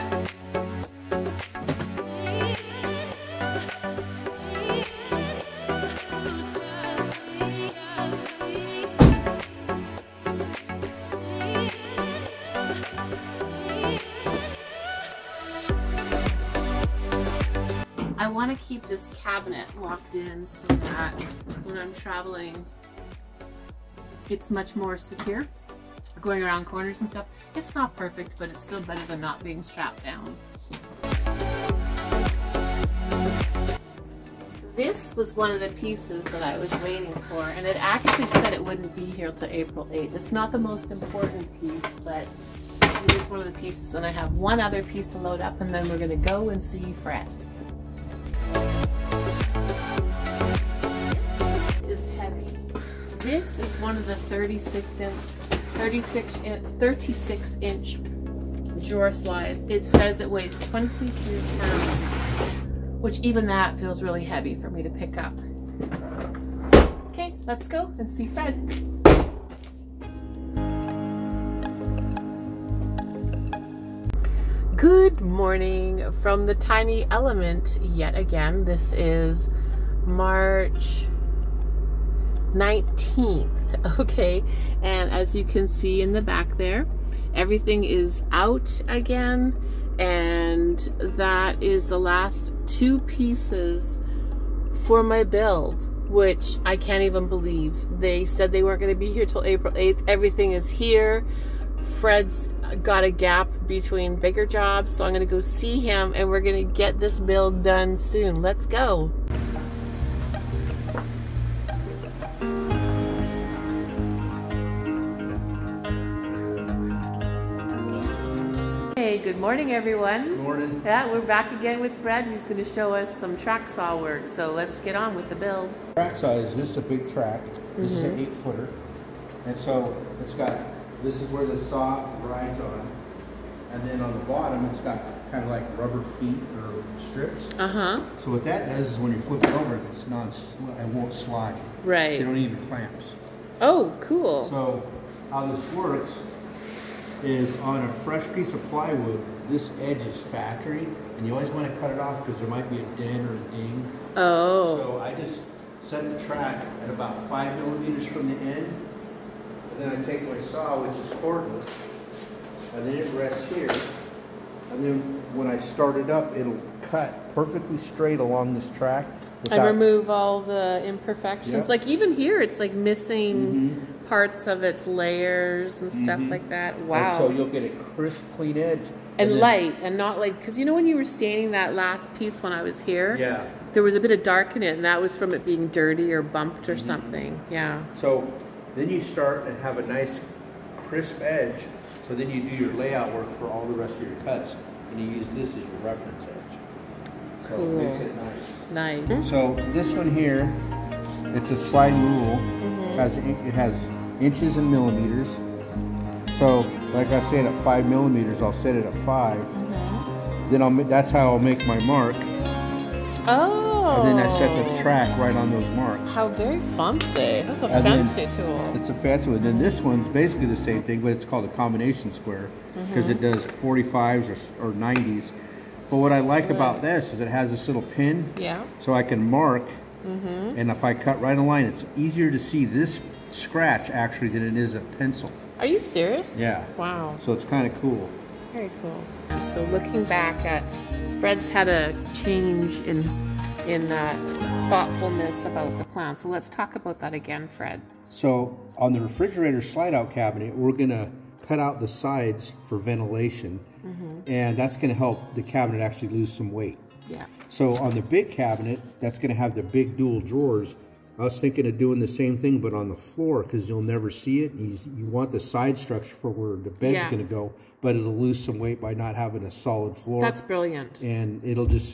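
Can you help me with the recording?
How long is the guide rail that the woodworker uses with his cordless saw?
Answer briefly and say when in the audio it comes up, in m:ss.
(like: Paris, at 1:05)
8 feet, at 2:08.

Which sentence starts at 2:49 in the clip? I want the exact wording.
Without, and remove all the imperfections.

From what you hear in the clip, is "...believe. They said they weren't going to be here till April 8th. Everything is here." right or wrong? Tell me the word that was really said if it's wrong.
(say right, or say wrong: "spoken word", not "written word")
right.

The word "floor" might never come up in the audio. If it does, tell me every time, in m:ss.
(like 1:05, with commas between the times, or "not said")
4:22, 4:29.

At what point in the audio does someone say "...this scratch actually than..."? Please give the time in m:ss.
3:52.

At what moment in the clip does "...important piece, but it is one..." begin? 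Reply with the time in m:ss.
0:40.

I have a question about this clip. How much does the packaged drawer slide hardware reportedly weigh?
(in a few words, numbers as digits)
22 pounds.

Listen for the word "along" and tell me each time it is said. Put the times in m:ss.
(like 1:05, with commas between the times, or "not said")
2:48.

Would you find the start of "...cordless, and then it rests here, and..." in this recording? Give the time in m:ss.
2:41.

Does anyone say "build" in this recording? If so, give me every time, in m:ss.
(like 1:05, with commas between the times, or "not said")
1:35, 1:47, 2:05.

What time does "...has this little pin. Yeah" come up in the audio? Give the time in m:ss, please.
3:47.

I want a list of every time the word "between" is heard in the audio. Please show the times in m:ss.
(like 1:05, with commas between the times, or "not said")
1:43.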